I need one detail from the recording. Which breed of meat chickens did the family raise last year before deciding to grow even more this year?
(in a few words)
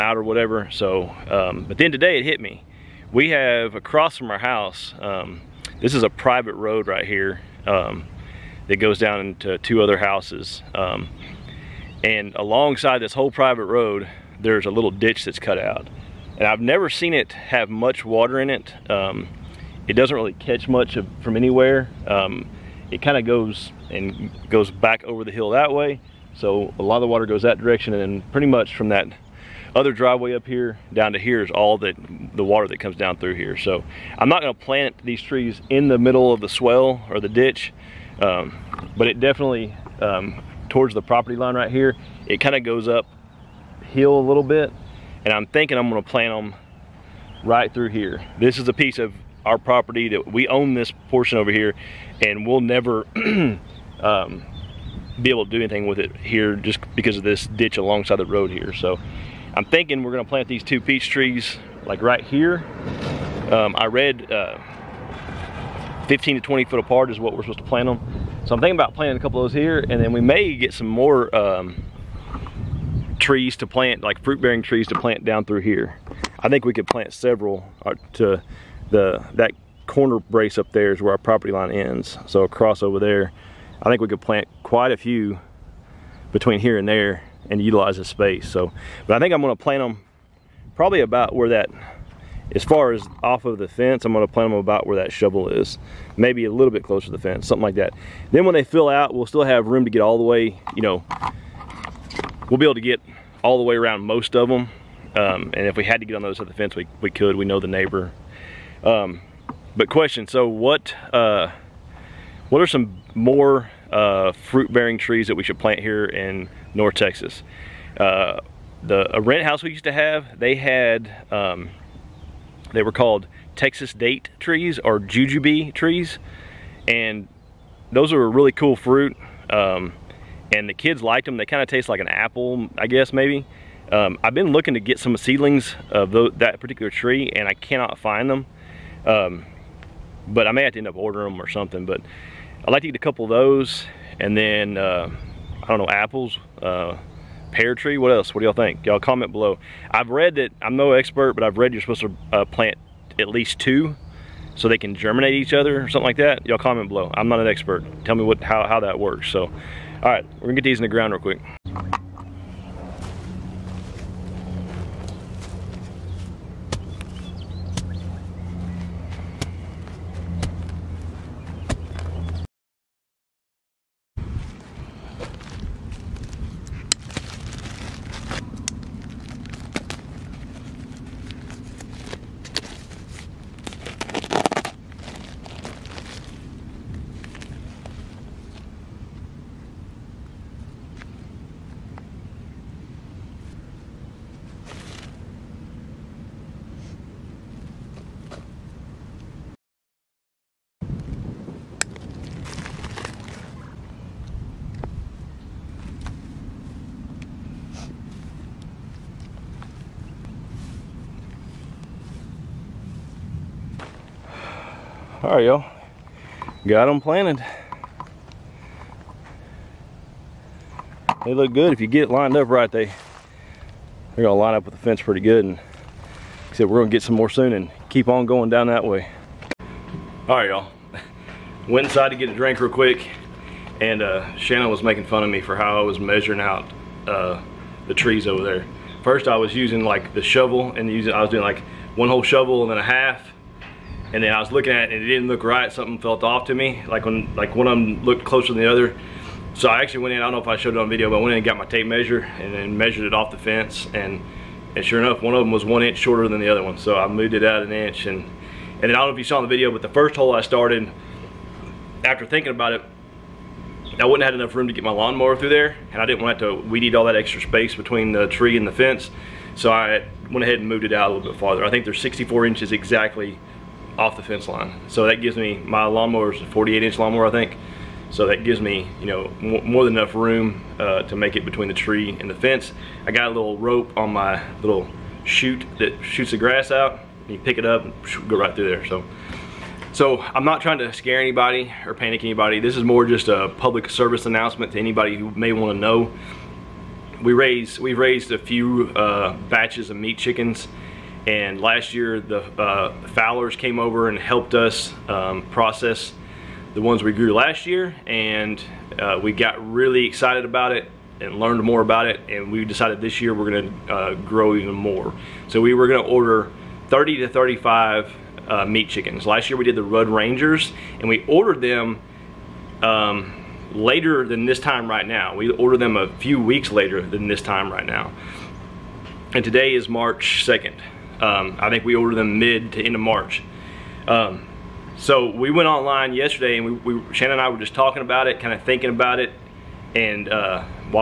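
Rudd Rangers.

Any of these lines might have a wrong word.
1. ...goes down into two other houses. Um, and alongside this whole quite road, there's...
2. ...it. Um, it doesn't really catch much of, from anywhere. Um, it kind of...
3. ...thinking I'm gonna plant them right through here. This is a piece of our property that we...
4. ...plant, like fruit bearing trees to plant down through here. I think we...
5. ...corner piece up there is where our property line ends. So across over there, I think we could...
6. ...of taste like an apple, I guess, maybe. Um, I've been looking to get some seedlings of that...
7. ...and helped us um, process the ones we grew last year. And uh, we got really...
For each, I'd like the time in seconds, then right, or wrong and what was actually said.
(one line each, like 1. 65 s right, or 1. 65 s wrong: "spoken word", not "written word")
1. 8 s wrong: "private", not "quite"
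2. 18 s right
3. 45 s right
4. 73 s right
5. 79 s wrong: "brace", not "piece"
6. 131 s right
7. 304 s right.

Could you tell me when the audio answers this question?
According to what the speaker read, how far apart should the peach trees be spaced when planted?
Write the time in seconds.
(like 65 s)
66 s.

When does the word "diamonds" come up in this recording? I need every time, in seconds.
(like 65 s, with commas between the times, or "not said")
not said.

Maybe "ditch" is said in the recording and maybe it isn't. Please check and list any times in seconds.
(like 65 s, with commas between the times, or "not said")
14 s, 37 s, 57 s.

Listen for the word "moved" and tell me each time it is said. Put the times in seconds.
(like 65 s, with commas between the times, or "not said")
257 s, 270 s.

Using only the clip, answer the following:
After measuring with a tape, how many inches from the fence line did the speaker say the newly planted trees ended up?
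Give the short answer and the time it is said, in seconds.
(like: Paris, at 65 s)
64, at 271 s.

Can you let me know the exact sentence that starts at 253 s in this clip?
And, and sure enough, one of them was one inch shorter than the other one.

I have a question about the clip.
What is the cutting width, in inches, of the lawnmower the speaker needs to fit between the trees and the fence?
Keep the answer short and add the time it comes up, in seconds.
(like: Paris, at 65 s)
48, at 276 s.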